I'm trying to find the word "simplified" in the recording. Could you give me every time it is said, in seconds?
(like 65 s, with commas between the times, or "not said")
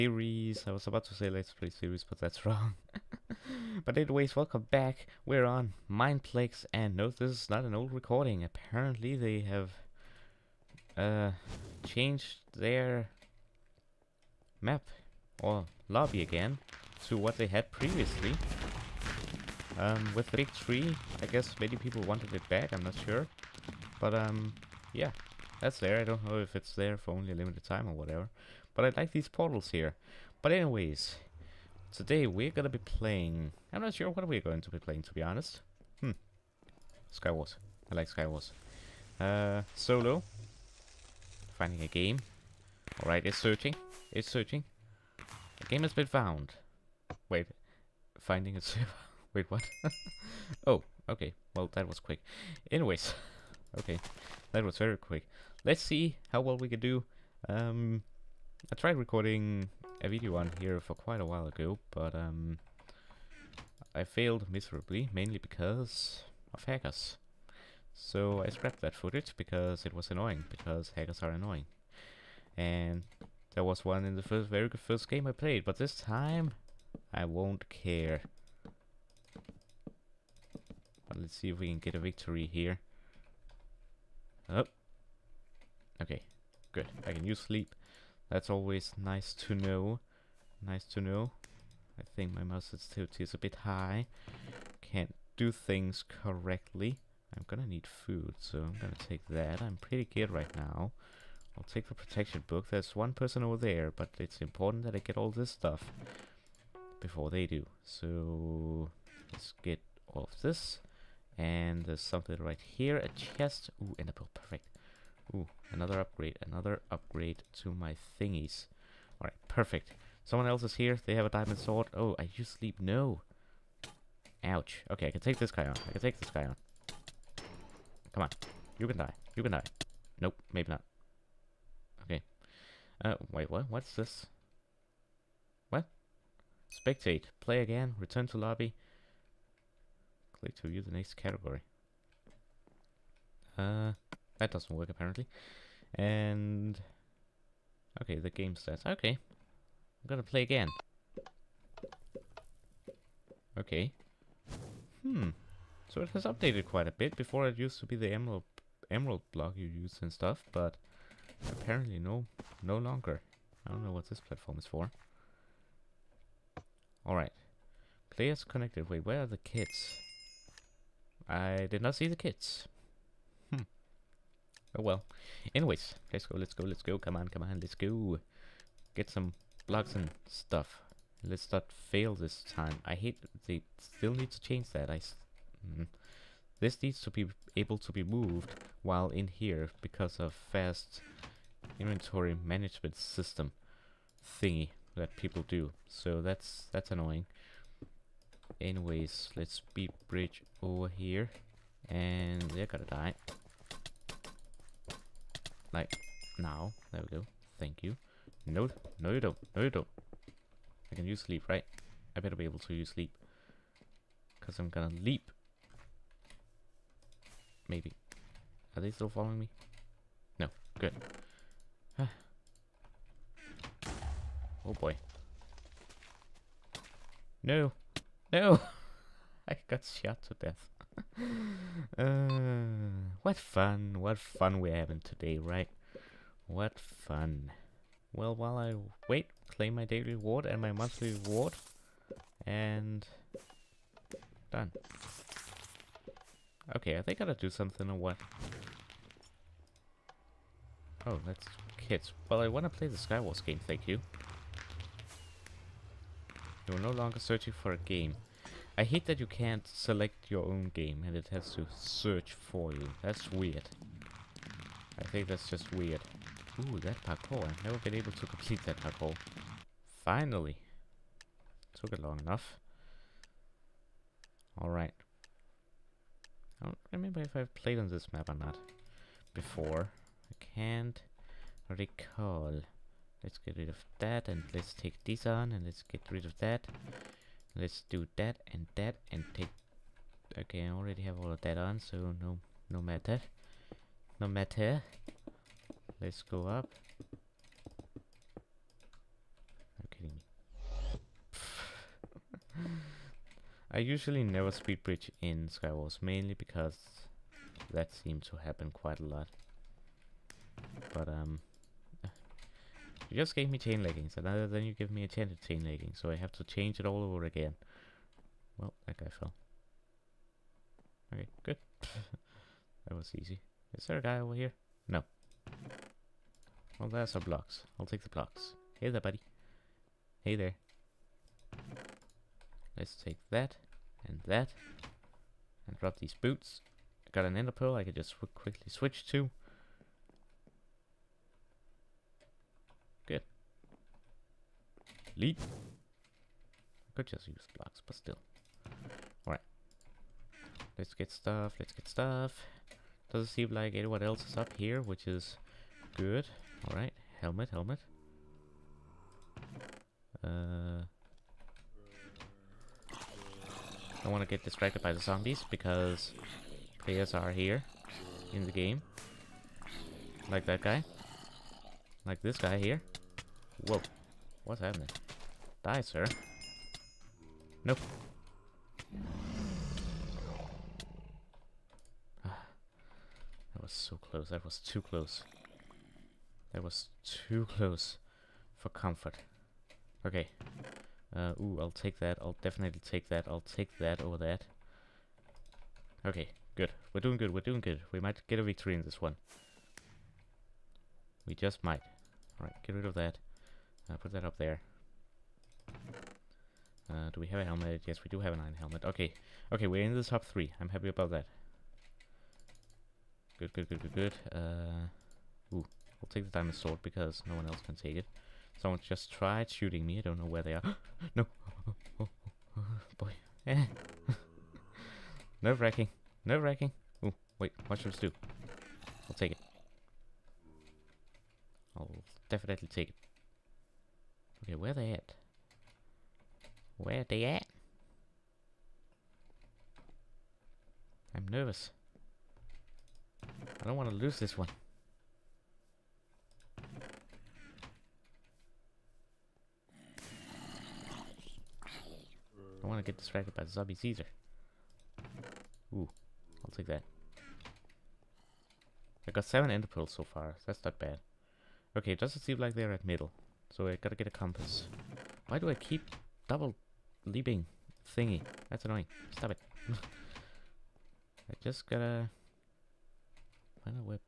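not said.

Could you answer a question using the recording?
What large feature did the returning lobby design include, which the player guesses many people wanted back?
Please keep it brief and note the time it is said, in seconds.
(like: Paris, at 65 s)
Big Tree, at 20 s.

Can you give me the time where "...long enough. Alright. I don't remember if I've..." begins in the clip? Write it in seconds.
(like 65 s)
272 s.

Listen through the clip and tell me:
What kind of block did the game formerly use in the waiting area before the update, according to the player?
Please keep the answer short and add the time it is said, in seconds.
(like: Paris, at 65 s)
emerald block, at 158 s.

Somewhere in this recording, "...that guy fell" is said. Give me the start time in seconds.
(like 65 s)
318 s.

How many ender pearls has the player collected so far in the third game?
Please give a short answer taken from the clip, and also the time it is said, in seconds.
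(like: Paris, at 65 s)
7, at 459 s.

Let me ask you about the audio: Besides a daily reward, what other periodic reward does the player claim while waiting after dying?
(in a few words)
monthly reward.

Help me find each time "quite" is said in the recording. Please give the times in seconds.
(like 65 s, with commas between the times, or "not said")
60 s, 156 s, 308 s.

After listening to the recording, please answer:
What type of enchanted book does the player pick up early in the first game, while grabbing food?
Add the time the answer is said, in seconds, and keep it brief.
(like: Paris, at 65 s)
protection book, at 101 s.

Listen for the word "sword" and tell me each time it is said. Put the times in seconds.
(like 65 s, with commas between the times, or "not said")
121 s, 416 s.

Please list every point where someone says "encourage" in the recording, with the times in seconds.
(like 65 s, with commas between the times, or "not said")
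not said.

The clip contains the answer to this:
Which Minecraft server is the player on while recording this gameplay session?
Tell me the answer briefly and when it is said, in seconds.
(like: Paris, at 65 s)
Mineplex, at 5 s.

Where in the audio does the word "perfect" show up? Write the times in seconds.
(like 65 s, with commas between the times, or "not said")
114 s, 119 s.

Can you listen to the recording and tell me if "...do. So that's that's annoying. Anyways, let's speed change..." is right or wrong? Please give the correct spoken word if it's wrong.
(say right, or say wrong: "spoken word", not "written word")
wrong: "bridge", not "change".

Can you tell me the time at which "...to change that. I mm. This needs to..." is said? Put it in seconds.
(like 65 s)
184 s.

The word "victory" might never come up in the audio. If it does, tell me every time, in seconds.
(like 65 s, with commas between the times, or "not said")
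81 s, 398 s.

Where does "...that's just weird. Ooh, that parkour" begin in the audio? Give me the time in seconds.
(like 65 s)
265 s.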